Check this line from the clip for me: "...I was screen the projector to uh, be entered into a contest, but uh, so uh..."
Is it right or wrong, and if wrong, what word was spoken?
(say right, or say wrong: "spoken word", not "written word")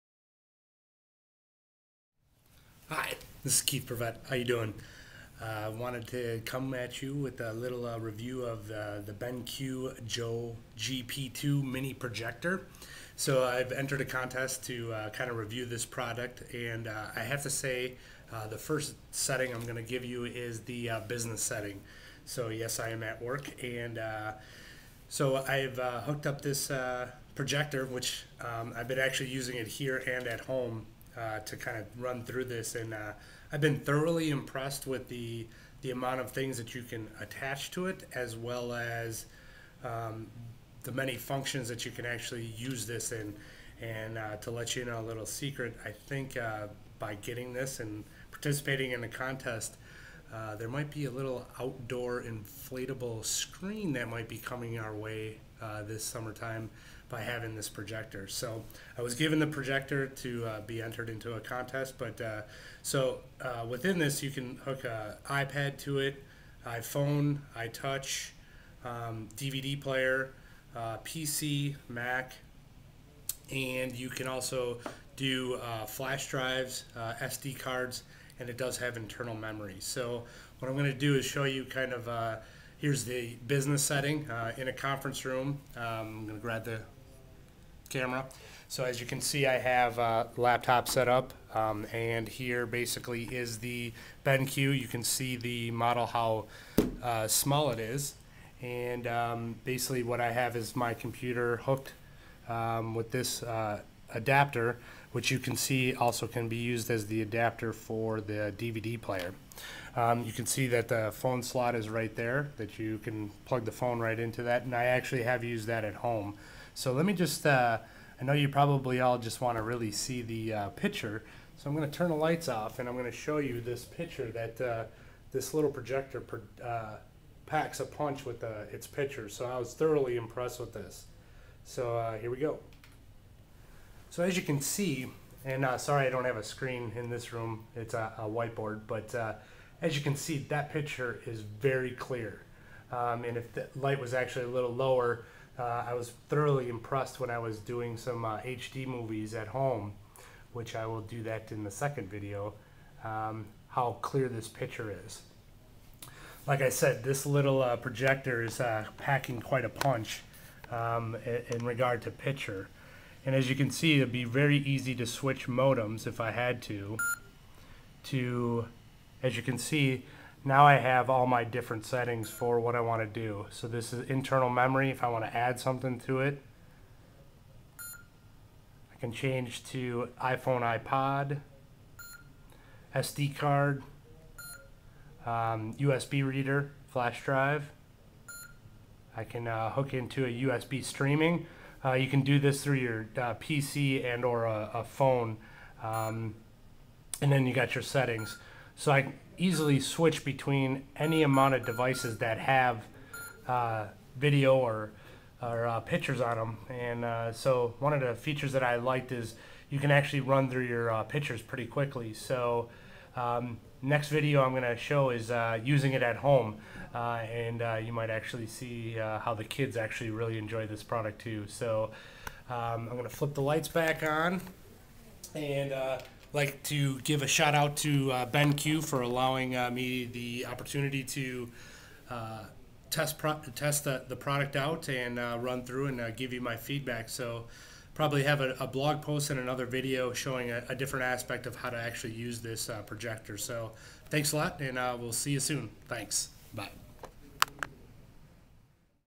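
wrong: "given", not "screen".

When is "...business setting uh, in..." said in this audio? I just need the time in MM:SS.
01:23.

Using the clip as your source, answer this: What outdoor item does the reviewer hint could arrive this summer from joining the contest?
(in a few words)
inflatable screen.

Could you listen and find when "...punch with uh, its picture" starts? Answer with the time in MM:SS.
02:07.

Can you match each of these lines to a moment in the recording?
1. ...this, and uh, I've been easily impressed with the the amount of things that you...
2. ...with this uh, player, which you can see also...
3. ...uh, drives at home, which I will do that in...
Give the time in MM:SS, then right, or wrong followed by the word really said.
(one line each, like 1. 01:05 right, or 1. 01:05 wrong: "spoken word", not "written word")
1. 00:32 wrong: "thoroughly", not "easily"
2. 01:42 wrong: "adapter", not "player"
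3. 02:28 wrong: "movies", not "drives".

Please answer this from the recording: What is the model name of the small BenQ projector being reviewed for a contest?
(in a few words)
Joybee GP2.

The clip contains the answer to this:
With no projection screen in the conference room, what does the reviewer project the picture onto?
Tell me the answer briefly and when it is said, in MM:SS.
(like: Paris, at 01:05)
whiteboard, at 02:18.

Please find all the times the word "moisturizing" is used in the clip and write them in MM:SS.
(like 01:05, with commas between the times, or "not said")
not said.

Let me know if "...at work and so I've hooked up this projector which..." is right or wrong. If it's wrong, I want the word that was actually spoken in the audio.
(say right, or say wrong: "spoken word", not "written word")
right.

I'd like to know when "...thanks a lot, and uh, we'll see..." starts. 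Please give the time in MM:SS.
04:04.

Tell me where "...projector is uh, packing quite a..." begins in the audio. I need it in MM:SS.
02:37.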